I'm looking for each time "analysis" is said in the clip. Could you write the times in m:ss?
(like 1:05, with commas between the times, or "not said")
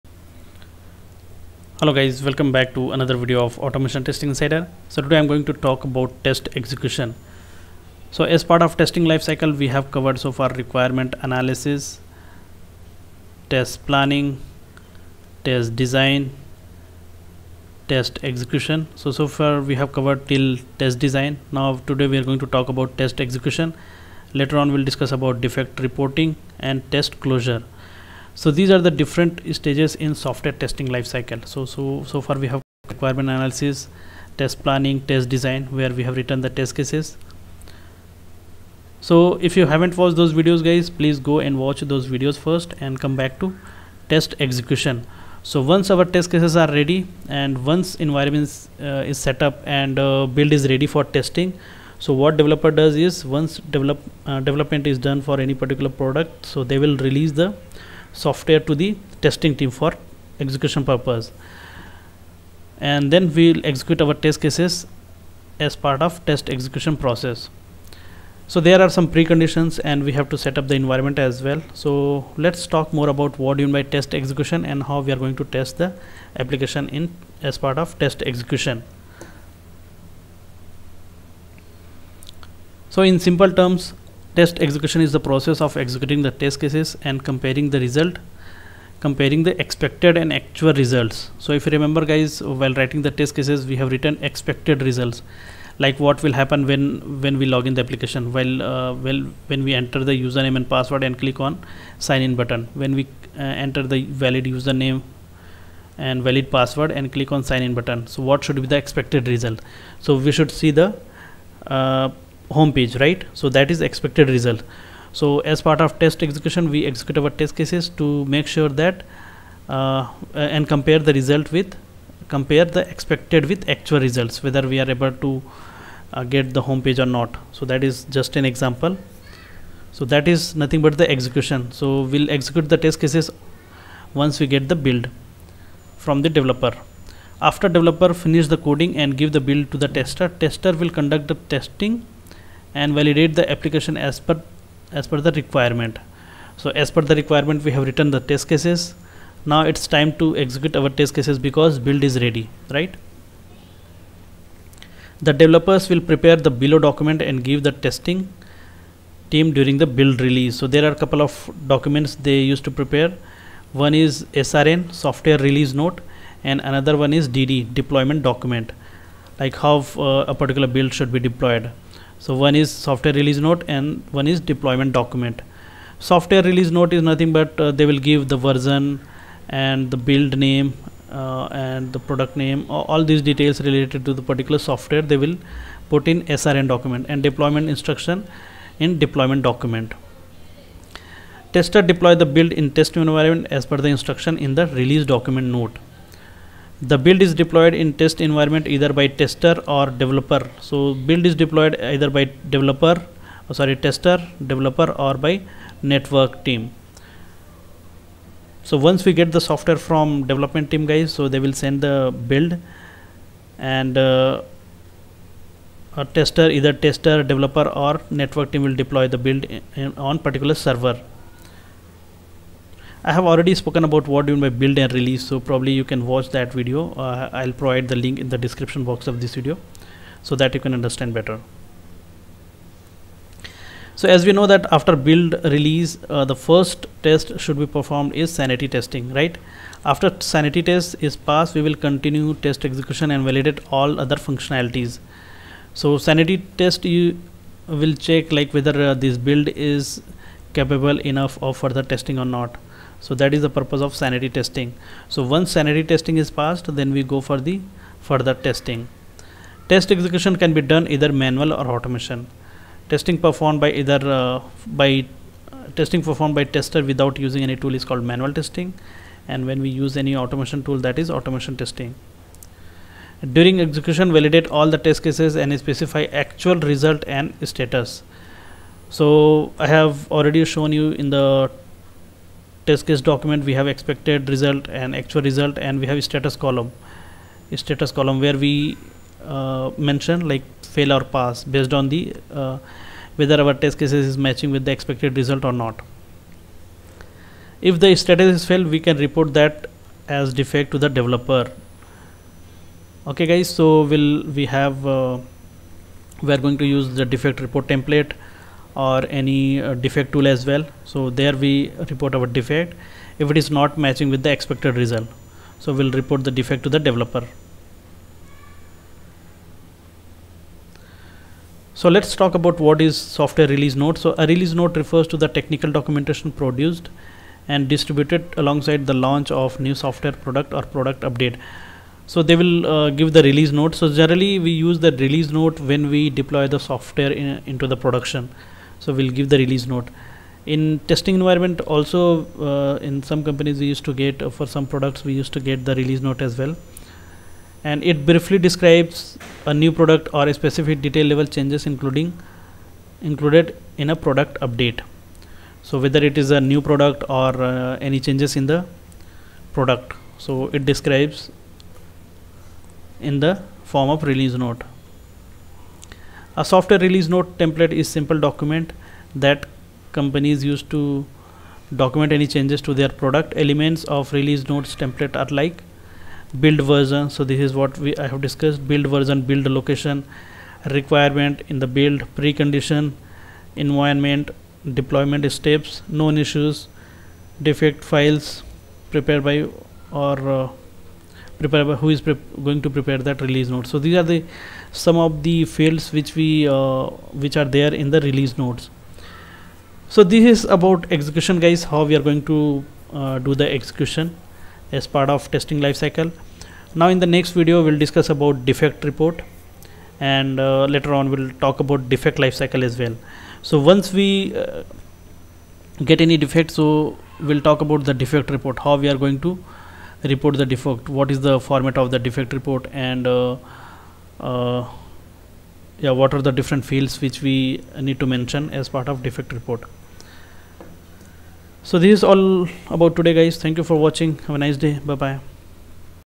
0:11, 0:33.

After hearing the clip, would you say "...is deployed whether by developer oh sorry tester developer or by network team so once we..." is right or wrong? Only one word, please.
wrong.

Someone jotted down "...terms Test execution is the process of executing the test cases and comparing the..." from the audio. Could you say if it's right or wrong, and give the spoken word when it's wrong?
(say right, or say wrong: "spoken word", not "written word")
right.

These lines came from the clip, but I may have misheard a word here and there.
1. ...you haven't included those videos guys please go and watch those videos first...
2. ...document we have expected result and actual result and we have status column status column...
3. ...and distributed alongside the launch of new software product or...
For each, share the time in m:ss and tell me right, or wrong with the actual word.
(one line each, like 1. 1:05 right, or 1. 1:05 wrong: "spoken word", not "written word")
1. 0:39 wrong: "watched", not "included"
2. 4:43 right
3. 5:27 right.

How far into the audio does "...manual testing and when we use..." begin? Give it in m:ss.
4:28.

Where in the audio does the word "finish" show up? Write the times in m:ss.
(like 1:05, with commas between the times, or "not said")
2:18.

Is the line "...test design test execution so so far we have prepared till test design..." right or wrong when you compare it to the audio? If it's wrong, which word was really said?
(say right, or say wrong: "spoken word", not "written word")
wrong: "covered", not "prepared".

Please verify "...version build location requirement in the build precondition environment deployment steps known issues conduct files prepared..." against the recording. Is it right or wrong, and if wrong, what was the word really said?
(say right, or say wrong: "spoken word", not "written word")
wrong: "defect", not "conduct".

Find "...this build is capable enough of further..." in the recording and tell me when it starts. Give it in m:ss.
4:08.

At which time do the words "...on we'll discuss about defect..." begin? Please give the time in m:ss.
0:24.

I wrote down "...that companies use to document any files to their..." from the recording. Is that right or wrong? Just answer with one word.
wrong.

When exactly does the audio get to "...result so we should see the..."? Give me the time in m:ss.
1:49.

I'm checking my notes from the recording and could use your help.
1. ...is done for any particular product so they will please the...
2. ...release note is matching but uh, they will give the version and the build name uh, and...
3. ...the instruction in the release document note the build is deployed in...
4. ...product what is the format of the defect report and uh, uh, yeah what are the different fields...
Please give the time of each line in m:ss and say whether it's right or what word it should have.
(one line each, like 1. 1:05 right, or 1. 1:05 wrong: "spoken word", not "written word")
1. 0:54 wrong: "release", not "please"
2. 2:56 wrong: "nothing", not "matching"
3. 3:13 right
4. 7:00 wrong: "defect", not "product".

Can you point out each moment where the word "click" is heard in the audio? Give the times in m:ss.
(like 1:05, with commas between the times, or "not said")
1:41, 1:47.